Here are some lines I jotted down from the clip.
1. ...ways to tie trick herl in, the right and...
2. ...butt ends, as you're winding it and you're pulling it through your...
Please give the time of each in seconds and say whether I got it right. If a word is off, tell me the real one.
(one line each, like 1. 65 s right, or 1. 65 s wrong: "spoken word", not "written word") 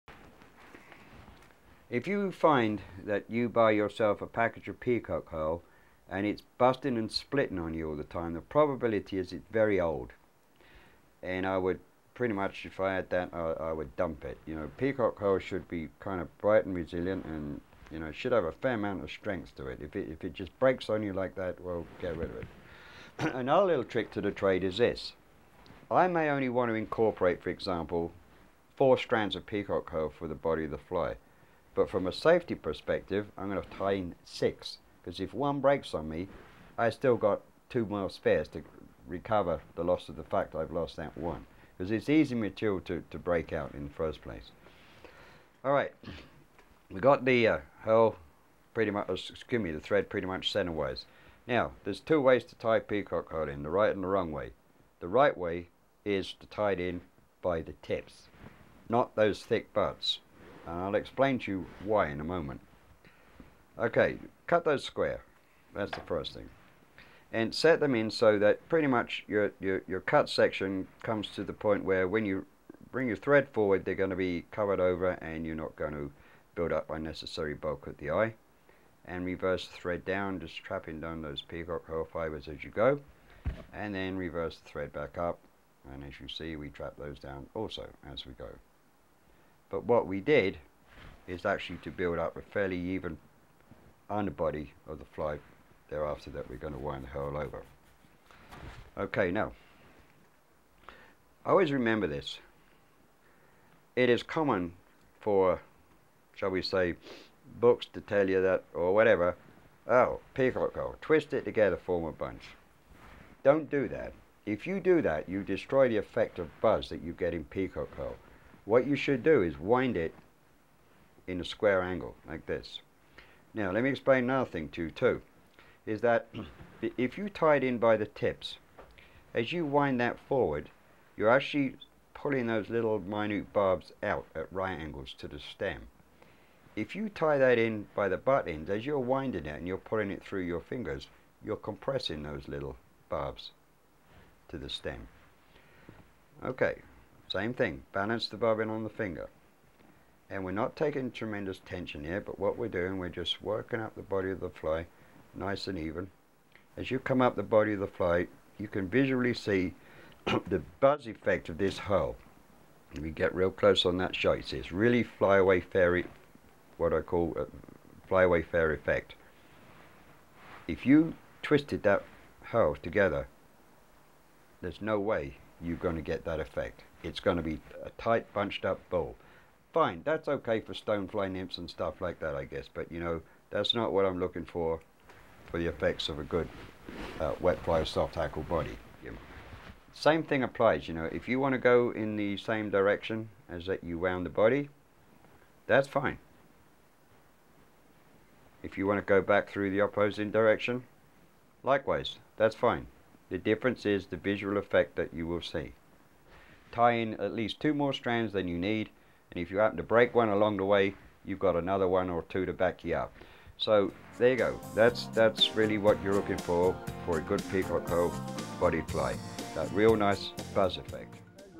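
1. 52 s wrong: "peacock", not "trick"
2. 138 s right.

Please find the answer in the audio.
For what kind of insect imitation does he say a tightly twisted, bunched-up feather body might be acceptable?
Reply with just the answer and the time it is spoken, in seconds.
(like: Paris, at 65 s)
stonefly nymphs, at 180 s.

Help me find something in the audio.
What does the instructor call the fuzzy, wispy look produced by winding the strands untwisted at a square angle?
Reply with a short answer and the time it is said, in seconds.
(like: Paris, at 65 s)
flyaway fair effect, at 168 s.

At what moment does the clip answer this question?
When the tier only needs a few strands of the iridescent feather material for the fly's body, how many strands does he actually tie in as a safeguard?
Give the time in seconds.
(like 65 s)
34 s.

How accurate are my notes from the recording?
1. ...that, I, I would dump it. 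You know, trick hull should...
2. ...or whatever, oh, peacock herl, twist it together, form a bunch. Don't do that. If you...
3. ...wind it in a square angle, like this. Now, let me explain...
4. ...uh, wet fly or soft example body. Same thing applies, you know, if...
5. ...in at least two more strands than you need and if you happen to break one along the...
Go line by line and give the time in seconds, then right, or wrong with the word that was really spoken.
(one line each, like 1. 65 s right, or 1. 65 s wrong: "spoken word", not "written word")
1. 13 s wrong: "peacock", not "trick"
2. 108 s right
3. 119 s right
4. 187 s wrong: "hackle", not "example"
5. 206 s right.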